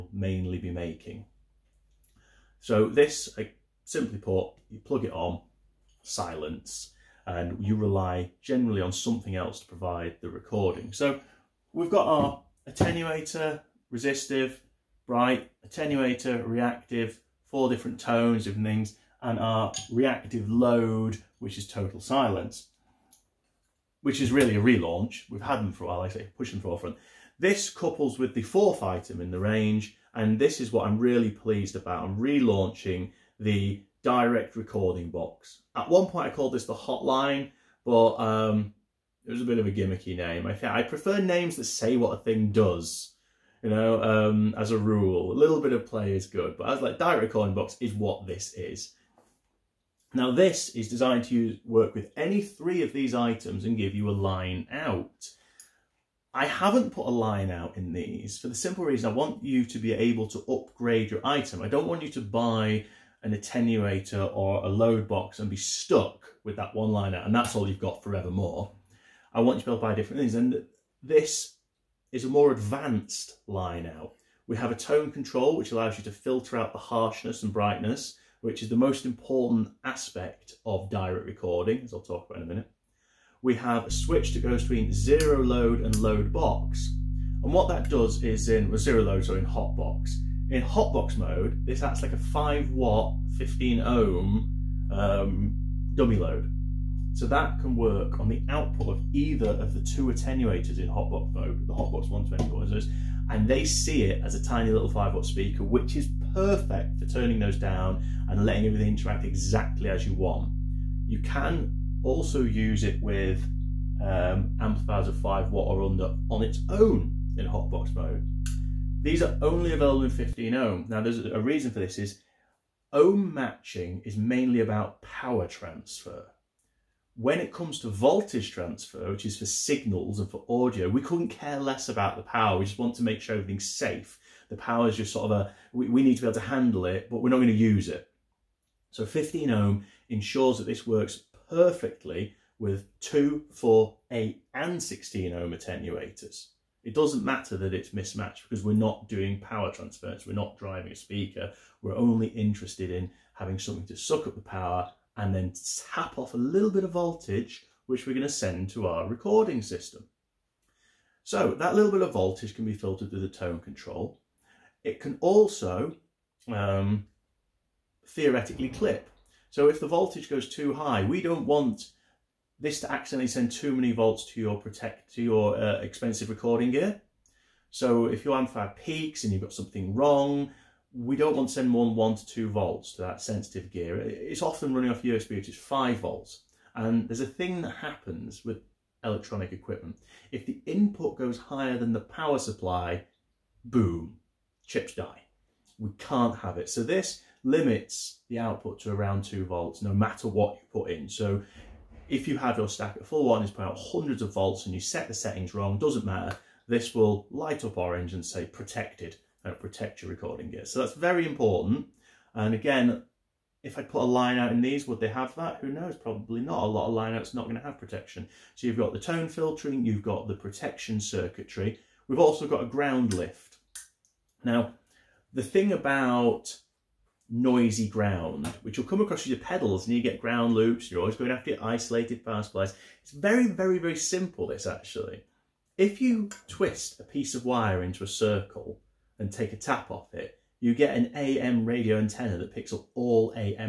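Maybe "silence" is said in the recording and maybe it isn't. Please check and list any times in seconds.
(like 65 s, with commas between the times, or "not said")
6 s, 21 s.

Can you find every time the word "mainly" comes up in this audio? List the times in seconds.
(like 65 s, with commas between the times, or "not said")
0 s, 124 s.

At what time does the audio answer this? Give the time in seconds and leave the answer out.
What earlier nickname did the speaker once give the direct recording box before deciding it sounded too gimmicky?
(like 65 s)
36 s.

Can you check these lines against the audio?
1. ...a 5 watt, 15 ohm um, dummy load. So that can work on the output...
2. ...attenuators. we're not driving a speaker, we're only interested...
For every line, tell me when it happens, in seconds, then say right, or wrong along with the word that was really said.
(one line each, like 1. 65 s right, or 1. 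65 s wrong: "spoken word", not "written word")
1. 92 s right
2. 149 s wrong: "transfers", not "attenuators".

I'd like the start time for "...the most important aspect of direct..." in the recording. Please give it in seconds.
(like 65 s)
78 s.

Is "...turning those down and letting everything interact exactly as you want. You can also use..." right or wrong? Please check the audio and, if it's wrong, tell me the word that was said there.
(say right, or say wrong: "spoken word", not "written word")
right.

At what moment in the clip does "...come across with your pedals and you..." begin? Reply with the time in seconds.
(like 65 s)
228 s.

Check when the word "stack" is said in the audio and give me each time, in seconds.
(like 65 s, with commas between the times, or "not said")
202 s.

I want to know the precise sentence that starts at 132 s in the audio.
We just want to make sure everything's safe.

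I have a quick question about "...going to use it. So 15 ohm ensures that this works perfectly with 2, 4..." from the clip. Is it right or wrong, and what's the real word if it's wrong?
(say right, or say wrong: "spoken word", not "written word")
right.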